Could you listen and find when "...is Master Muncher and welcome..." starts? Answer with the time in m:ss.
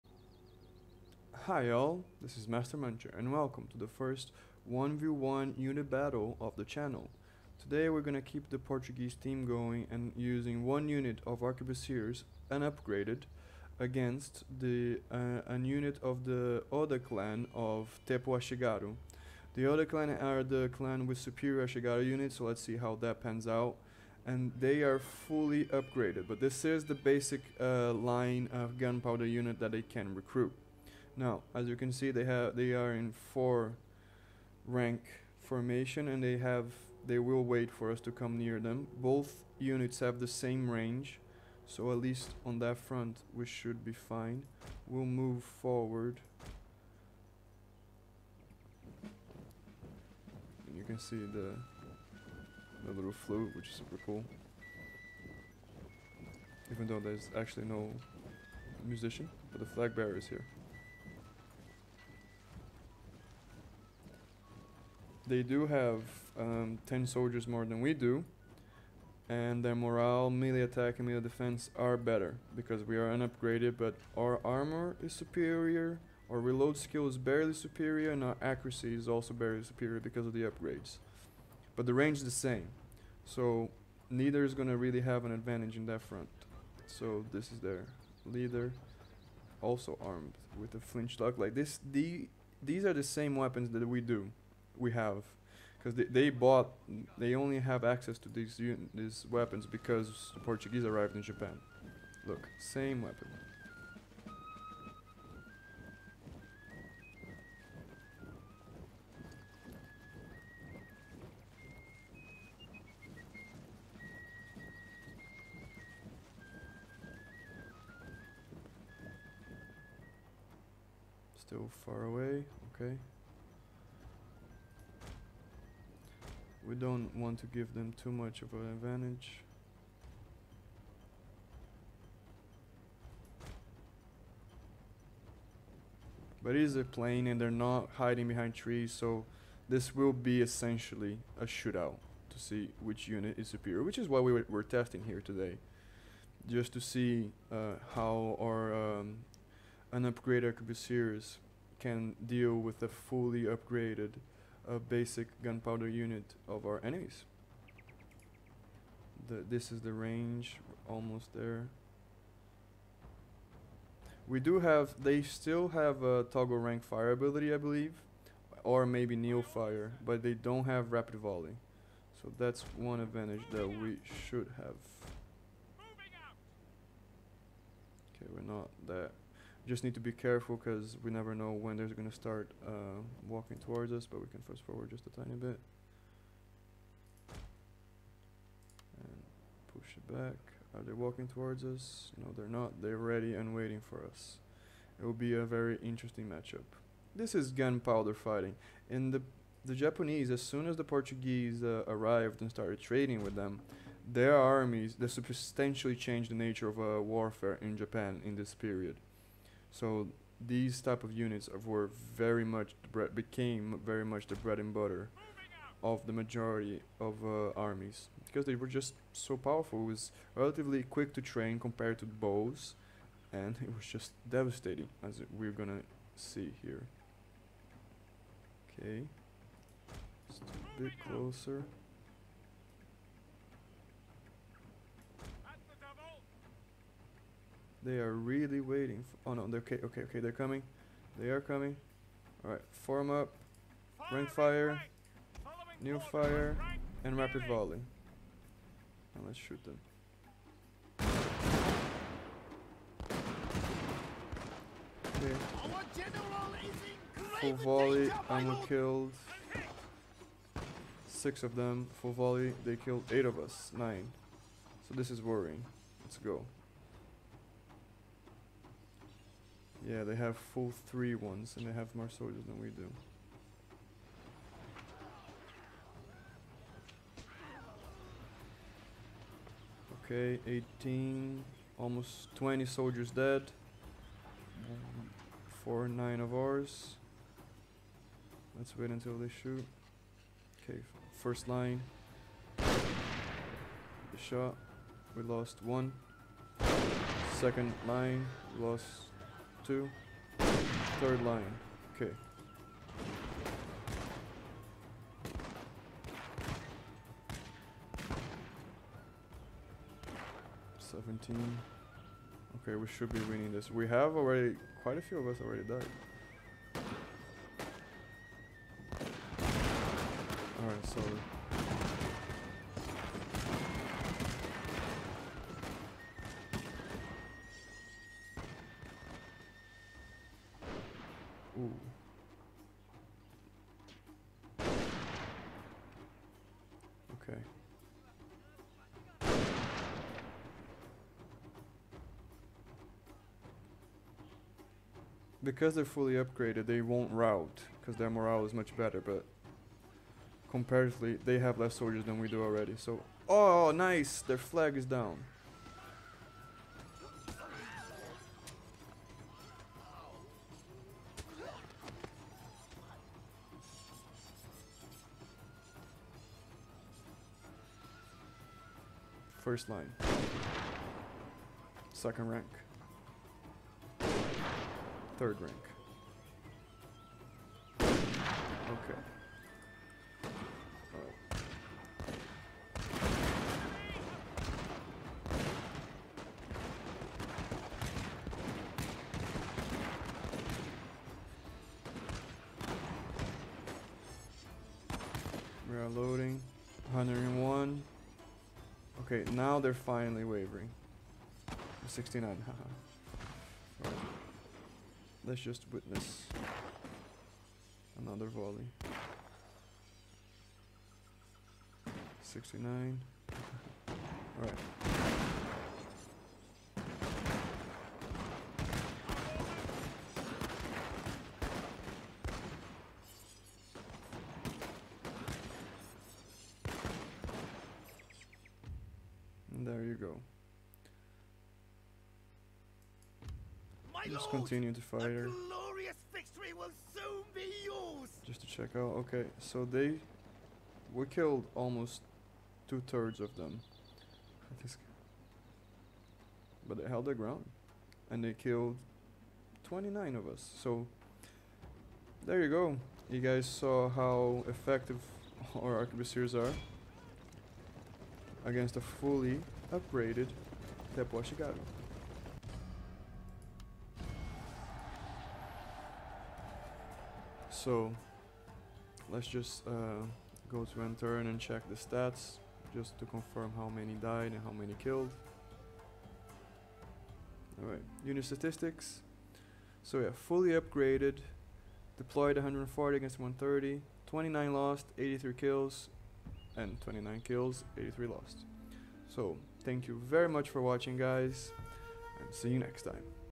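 0:02.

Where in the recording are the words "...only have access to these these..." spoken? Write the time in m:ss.
1:37.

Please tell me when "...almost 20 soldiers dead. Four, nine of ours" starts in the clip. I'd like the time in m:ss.
4:41.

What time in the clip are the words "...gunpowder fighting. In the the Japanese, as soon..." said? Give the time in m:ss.
3:17.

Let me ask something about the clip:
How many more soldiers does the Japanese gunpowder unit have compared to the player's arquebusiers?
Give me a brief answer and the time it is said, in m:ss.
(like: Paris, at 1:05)
10, at 1:06.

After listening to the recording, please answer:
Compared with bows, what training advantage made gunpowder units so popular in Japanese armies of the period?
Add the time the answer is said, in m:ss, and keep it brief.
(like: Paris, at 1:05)
relatively quick to train, at 3:40.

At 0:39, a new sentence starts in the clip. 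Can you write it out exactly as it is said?
Both units have the same range, so at least on that front we should be fine.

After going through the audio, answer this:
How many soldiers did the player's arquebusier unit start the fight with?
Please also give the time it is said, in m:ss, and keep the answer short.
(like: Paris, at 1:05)
140, at 8:02.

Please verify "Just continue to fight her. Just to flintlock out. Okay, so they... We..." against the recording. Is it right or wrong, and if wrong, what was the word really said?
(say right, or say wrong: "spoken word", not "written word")
wrong: "check", not "flintlock".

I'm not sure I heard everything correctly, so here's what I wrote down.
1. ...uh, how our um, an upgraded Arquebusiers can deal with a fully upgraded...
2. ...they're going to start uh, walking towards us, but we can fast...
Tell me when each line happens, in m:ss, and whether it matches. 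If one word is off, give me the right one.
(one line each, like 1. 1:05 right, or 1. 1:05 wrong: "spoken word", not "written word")
1. 2:27 right
2. 3:01 right.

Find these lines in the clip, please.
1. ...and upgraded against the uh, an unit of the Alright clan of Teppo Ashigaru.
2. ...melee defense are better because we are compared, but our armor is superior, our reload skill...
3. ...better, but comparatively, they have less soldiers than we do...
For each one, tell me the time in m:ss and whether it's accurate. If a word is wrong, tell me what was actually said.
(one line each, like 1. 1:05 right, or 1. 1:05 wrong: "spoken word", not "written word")
1. 0:12 wrong: "Oda", not "Alright"
2. 1:11 wrong: "unupgraded", not "compared"
3. 5:48 right.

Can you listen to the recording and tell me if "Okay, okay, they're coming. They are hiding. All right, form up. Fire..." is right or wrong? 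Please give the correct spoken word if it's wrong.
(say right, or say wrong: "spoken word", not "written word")
wrong: "coming", not "hiding".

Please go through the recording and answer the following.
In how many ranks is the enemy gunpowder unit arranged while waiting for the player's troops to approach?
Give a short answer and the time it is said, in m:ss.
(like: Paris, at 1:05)
4, at 0:33.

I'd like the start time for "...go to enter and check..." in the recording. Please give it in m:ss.
7:50.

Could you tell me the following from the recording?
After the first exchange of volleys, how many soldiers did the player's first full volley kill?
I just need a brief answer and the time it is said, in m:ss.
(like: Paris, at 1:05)
6, at 4:21.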